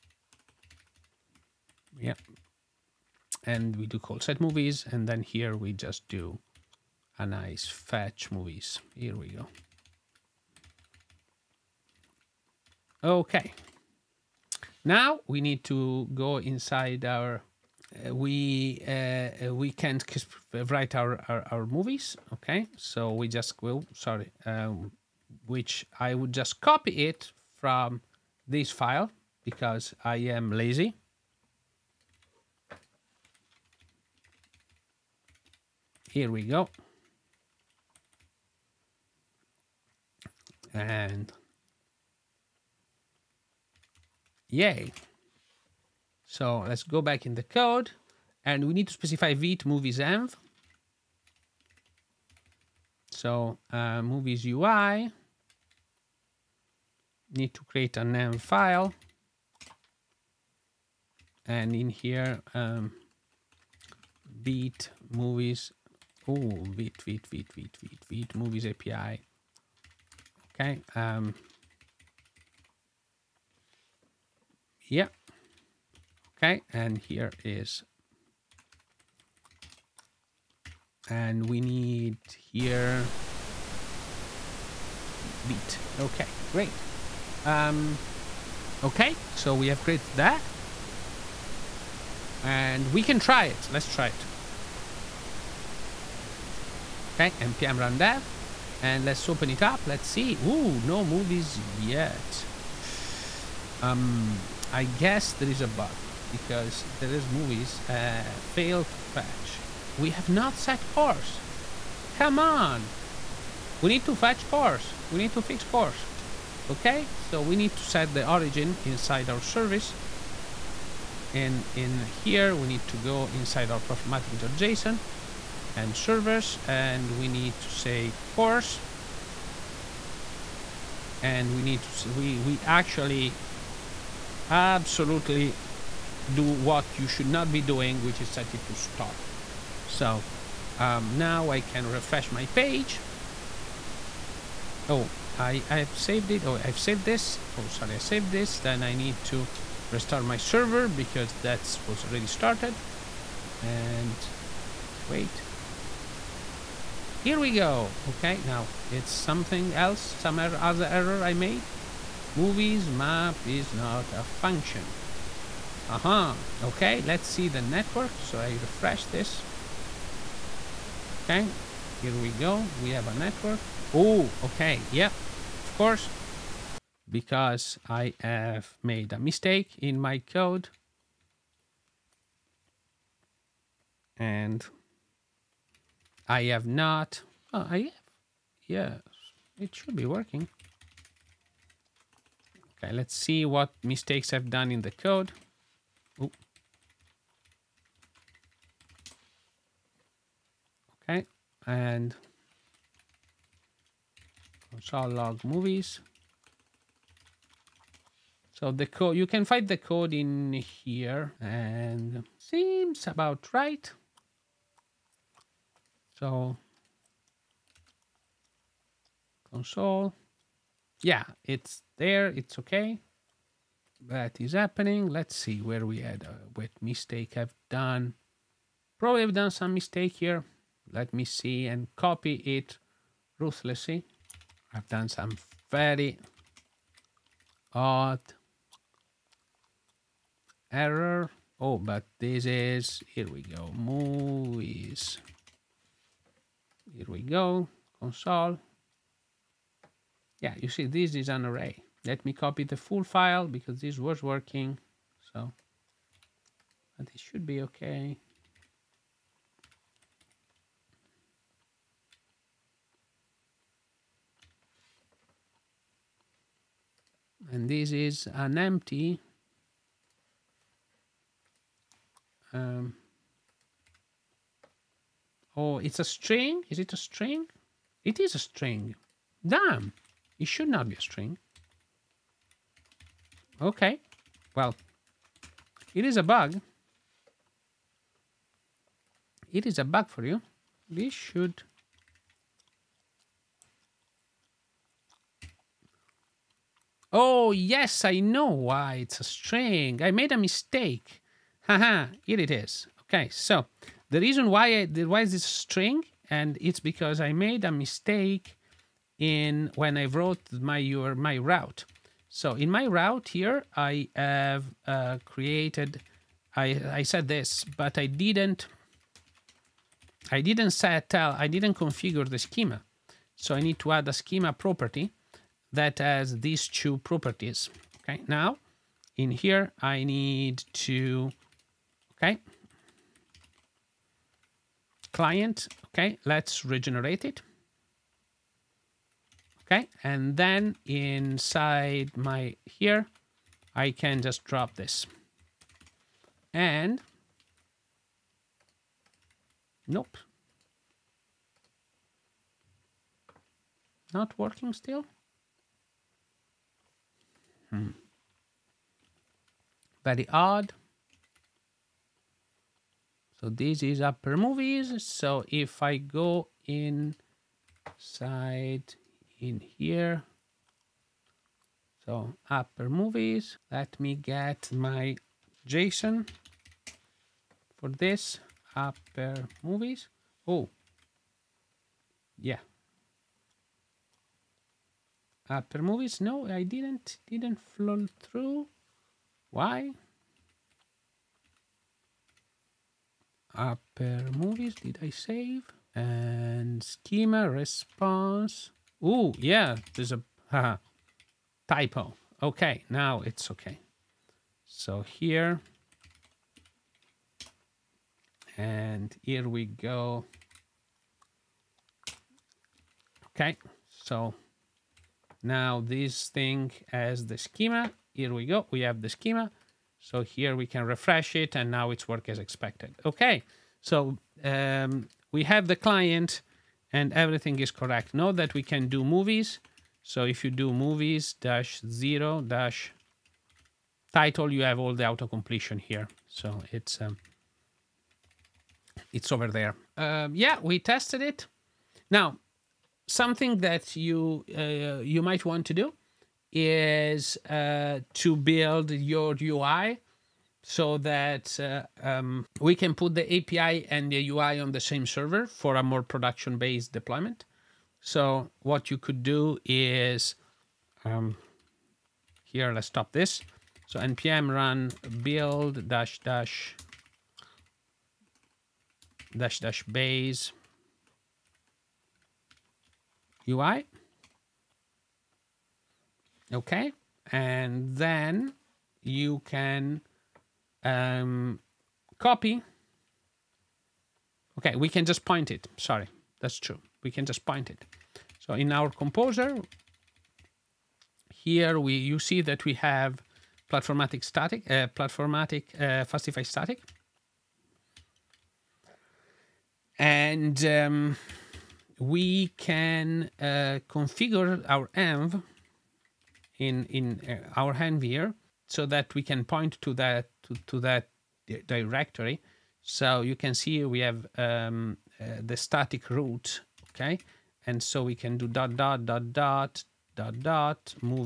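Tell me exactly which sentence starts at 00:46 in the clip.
So let's go back in the code and we need to specify v to movies env.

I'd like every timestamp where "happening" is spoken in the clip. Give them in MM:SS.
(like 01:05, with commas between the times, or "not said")
03:44.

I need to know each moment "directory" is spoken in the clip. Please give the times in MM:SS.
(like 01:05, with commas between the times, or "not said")
08:31.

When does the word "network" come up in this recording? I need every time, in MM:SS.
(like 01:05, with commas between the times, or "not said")
02:47, 02:53.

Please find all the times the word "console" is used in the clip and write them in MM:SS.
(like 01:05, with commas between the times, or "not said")
03:24, 03:39, 04:08.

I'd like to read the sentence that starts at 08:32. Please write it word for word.
So you can see we have um, uh, the static root, okay?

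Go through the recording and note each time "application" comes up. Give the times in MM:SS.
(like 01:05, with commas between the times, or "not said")
not said.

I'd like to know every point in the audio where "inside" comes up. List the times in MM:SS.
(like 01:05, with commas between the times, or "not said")
00:16, 01:58, 02:03, 05:40, 06:06.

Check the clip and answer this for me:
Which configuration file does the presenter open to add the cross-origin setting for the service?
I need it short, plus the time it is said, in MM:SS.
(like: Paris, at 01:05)
platformatic.json, at 02:03.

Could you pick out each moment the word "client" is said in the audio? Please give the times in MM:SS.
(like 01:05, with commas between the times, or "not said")
05:35, 07:05.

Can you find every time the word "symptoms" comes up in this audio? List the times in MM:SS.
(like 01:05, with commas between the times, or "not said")
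not said.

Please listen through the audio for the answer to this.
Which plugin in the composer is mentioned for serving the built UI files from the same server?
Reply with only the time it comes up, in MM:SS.
08:16.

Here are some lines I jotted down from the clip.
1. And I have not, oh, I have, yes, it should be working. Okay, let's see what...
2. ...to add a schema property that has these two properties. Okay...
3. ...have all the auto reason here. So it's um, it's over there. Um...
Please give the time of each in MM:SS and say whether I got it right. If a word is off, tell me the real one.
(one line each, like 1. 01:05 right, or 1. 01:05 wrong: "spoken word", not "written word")
1. 03:04 right
2. 05:23 right
3. 07:14 wrong: "completion", not "reason".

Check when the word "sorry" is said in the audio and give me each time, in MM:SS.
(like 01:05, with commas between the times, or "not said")
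00:23, 02:27, 08:05.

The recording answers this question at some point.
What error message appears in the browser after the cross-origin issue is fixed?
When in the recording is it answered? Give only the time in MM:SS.
02:42.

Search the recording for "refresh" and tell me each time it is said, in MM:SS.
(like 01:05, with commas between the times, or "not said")
02:21, 02:48, 07:00.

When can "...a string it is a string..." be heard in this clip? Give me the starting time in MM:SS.
04:36.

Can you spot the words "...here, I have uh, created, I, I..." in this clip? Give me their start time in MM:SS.
05:13.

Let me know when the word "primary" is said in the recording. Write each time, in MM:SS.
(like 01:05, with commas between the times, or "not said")
not said.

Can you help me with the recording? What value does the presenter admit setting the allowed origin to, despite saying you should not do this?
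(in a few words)
star.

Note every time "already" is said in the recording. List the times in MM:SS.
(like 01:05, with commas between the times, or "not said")
02:32.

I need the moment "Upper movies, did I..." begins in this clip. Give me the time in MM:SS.
06:33.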